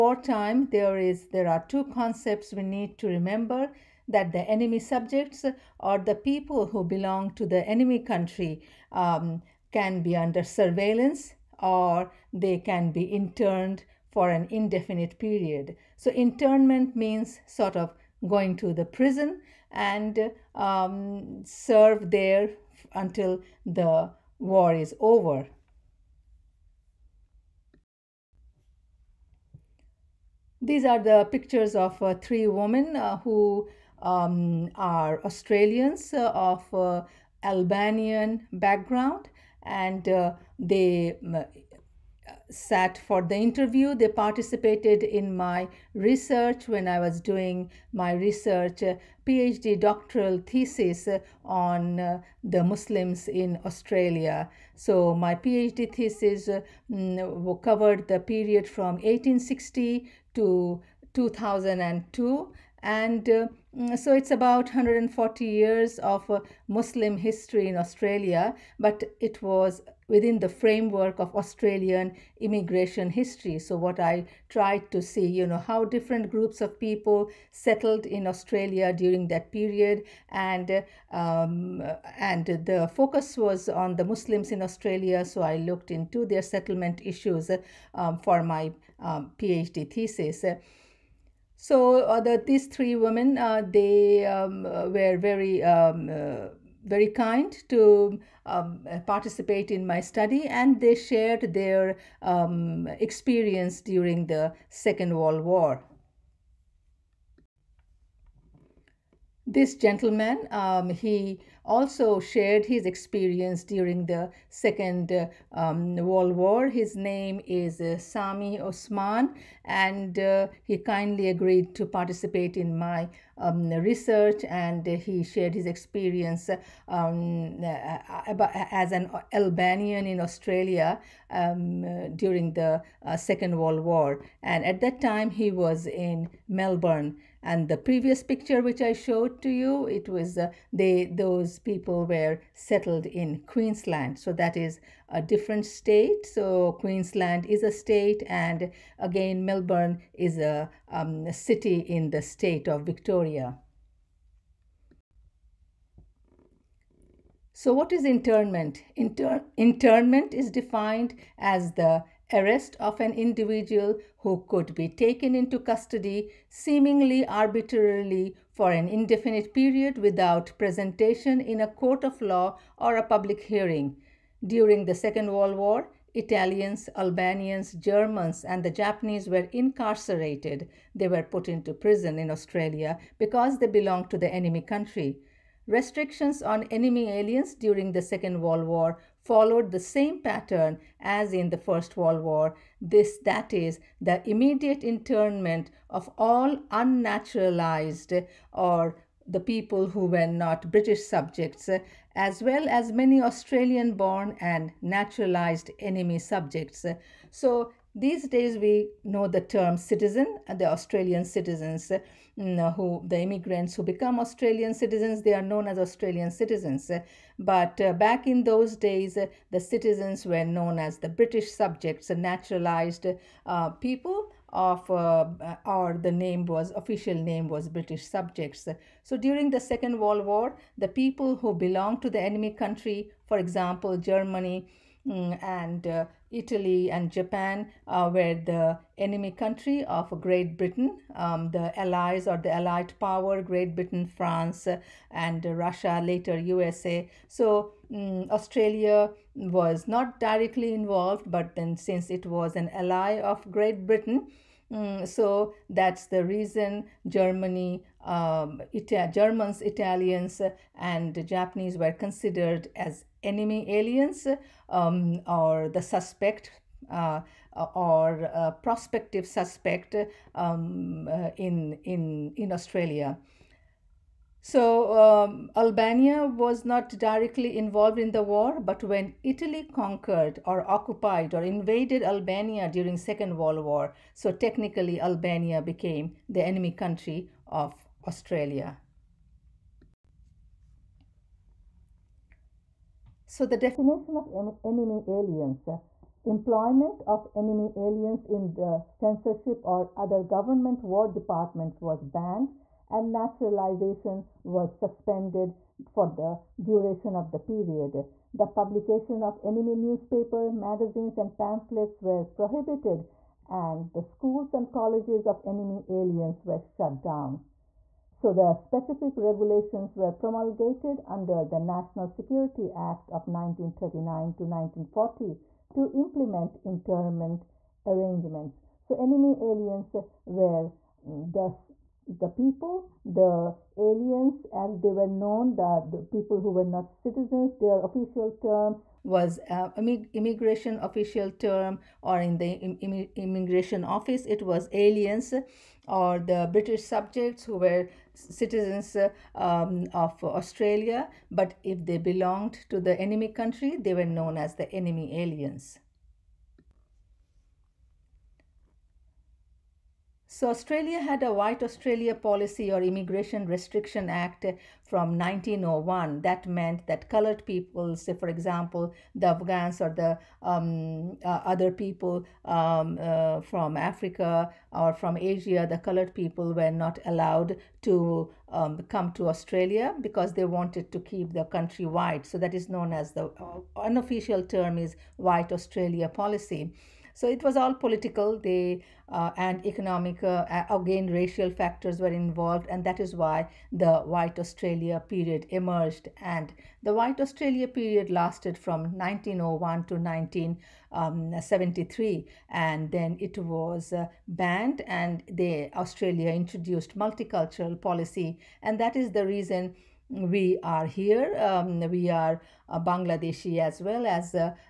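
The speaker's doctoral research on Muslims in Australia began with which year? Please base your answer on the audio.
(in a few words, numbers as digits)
1860.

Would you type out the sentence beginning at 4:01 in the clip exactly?
Um, the allies or the allied power, Great Britain, France, uh, and Russia, later USA.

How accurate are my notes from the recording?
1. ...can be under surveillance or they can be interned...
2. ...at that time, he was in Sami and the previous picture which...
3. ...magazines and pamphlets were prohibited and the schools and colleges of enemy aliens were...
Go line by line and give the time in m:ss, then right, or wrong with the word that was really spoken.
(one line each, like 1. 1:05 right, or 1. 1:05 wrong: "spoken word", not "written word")
1. 0:09 right
2. 2:14 wrong: "Melbourne", not "Sami"
3. 5:10 right.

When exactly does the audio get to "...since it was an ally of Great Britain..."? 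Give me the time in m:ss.
4:11.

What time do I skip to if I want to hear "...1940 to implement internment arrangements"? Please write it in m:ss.
5:24.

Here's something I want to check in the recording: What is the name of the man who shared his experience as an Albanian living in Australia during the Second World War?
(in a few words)
Sami Osman.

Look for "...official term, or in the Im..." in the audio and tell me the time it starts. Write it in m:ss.
5:40.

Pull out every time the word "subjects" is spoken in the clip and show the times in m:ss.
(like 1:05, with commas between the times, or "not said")
0:04, 3:21, 3:26, 3:41, 3:48, 5:46.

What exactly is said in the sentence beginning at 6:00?
So, Australia had a White Australia Policy or Immigration Restriction Act from 1901.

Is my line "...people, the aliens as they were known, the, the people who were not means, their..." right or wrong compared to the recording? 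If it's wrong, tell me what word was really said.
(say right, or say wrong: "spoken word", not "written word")
wrong: "citizens", not "means".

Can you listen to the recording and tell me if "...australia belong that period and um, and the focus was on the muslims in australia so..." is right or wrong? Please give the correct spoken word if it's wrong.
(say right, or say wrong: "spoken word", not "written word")
wrong: "during", not "belong".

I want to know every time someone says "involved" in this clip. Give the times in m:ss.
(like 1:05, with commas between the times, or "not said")
4:10, 4:37, 6:32.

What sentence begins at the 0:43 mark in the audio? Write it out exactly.
They participated in my research when I was doing my research, uh, PhD doctoral thesis uh, on uh, the Muslims in Australia.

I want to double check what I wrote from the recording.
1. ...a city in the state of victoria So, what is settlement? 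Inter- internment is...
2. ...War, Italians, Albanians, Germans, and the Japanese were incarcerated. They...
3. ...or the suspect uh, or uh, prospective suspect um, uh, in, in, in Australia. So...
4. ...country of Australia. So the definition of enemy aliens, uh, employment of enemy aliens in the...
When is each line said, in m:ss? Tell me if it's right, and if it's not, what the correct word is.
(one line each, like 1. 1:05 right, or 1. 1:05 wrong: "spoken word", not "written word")
1. 2:31 wrong: "internment", not "settlement"
2. 2:55 right
3. 4:25 right
4. 4:46 right.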